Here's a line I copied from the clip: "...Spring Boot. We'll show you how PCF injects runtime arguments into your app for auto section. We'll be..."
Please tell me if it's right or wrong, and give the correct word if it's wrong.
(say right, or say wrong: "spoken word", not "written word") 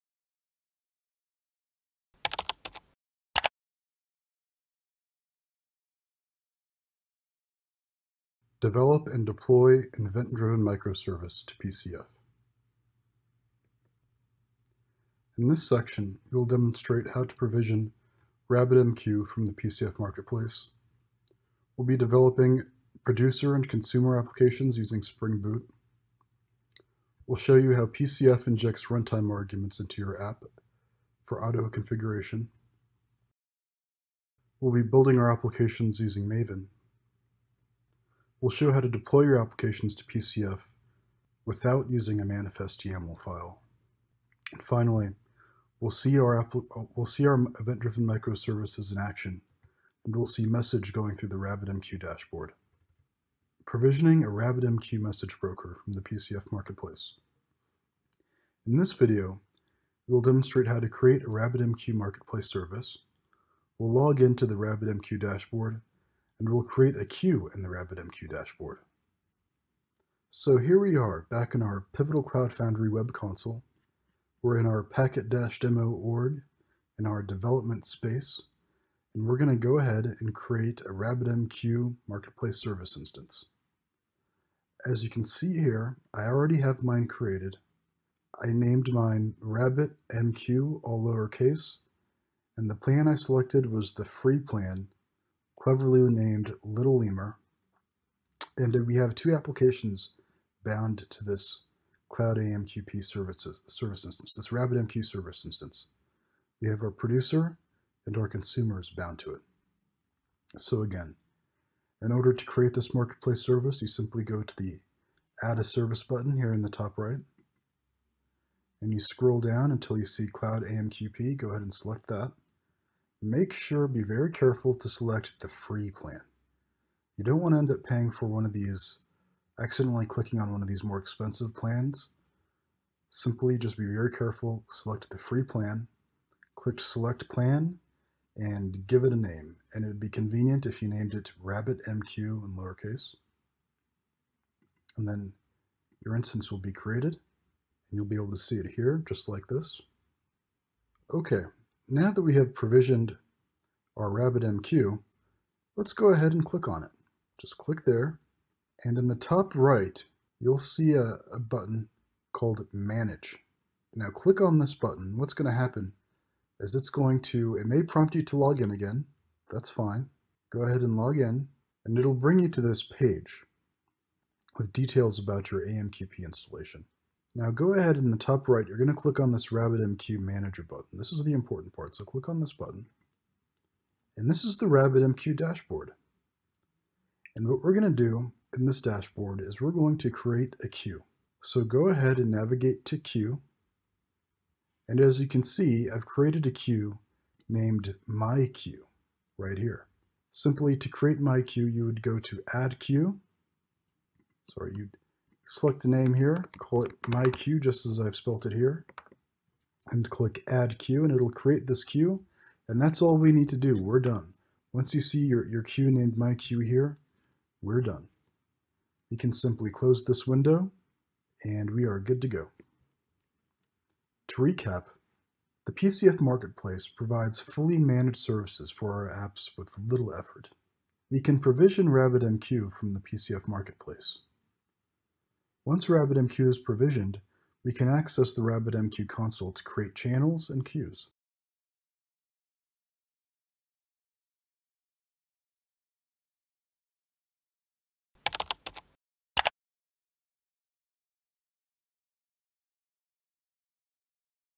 wrong: "configuration", not "section".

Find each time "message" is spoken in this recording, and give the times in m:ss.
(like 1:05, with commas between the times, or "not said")
0:50, 0:54.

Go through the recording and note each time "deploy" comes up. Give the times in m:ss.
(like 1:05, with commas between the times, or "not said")
0:09, 0:38.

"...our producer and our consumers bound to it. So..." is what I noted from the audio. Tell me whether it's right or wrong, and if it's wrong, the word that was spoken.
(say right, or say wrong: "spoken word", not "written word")
right.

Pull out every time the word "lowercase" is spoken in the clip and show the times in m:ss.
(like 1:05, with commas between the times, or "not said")
1:31, 2:22.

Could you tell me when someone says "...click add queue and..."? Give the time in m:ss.
3:30.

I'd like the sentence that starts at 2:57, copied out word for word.
Now go ahead in the top right, you're going to click on this RabbitMQ Manager button.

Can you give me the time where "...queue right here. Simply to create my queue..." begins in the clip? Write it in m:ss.
3:18.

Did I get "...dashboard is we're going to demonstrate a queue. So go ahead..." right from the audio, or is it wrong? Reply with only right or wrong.
wrong.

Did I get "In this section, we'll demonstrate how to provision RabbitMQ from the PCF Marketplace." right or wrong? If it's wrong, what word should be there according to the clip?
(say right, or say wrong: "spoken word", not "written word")
right.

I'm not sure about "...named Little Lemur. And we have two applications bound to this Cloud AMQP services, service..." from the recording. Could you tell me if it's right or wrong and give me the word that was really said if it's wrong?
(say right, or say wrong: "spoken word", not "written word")
right.